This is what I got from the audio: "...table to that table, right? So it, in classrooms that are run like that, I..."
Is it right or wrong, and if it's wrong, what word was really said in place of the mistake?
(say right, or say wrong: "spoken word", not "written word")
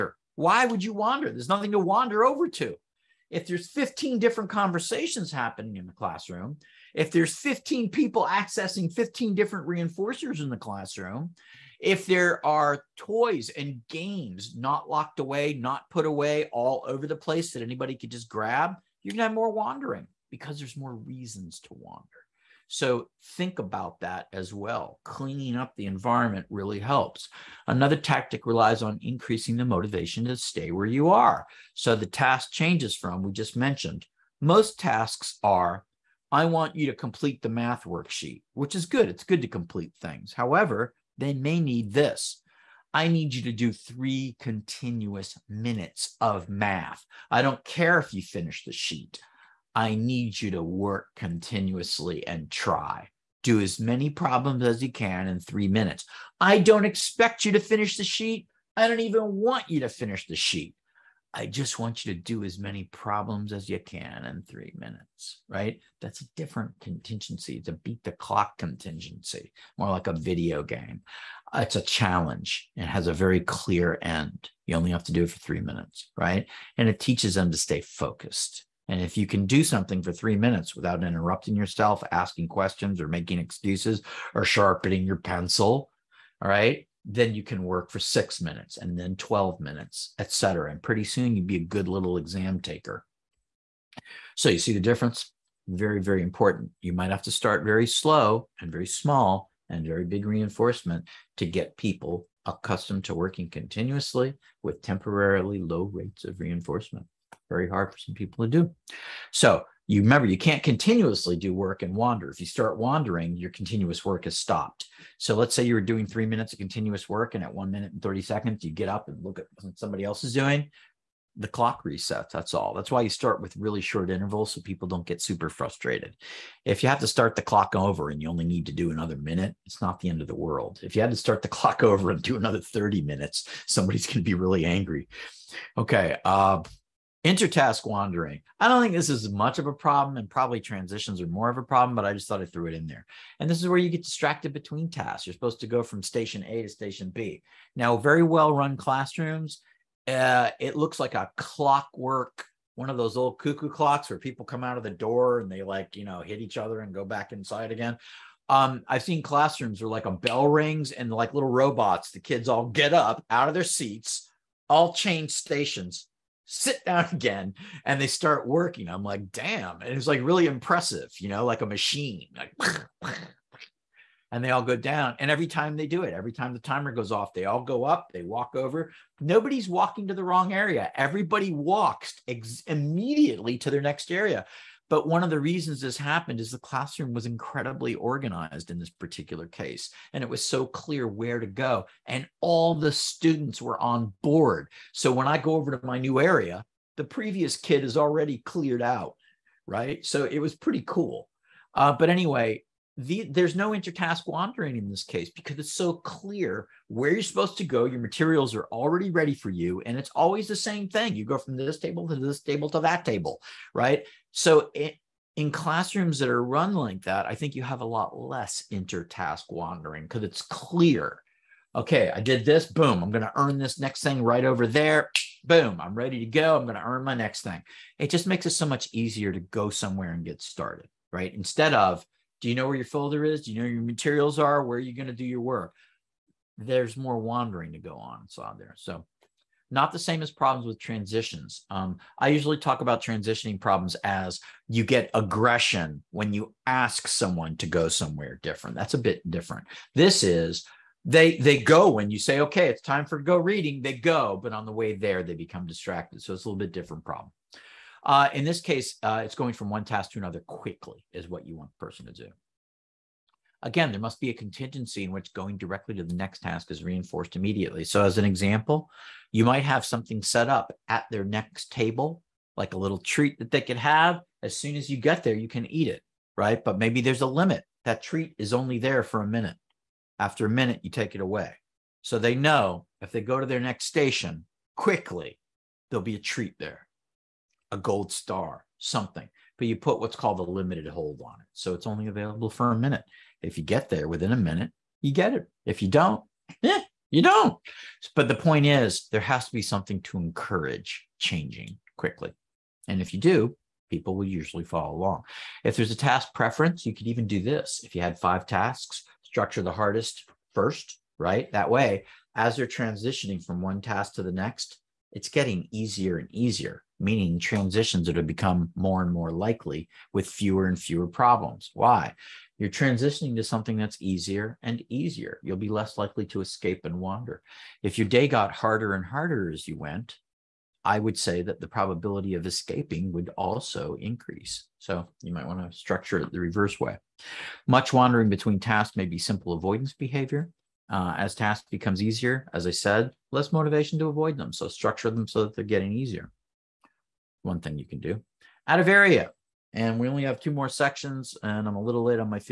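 right.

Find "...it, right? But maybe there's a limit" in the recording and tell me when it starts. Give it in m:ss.
4:35.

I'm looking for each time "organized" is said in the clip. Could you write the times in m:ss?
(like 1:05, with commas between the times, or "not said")
3:07.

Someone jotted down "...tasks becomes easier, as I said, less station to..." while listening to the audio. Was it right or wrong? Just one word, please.
wrong.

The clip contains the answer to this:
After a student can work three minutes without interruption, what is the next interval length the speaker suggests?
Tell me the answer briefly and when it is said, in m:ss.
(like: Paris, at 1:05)
6 minutes, at 1:27.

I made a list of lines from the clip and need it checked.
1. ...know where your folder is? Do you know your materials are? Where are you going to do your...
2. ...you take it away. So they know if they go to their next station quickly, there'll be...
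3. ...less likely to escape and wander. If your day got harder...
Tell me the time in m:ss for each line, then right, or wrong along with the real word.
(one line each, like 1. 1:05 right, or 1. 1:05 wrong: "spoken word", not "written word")
1. 3:52 right
2. 4:40 right
3. 5:25 right.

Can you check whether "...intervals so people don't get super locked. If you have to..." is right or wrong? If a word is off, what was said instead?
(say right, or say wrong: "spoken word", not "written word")
wrong: "frustrated", not "locked".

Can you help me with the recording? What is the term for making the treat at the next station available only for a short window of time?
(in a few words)
Limited hold.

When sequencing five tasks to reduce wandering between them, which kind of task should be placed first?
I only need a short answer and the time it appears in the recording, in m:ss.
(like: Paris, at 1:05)
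The hardest, at 5:09.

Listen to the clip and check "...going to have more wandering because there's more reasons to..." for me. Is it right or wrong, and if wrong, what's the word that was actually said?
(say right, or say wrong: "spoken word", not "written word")
right.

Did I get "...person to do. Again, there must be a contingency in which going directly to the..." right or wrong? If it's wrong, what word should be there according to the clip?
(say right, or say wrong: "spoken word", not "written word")
right.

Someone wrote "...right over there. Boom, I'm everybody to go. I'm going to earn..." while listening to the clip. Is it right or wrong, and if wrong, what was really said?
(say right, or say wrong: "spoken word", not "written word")
wrong: "ready", not "everybody".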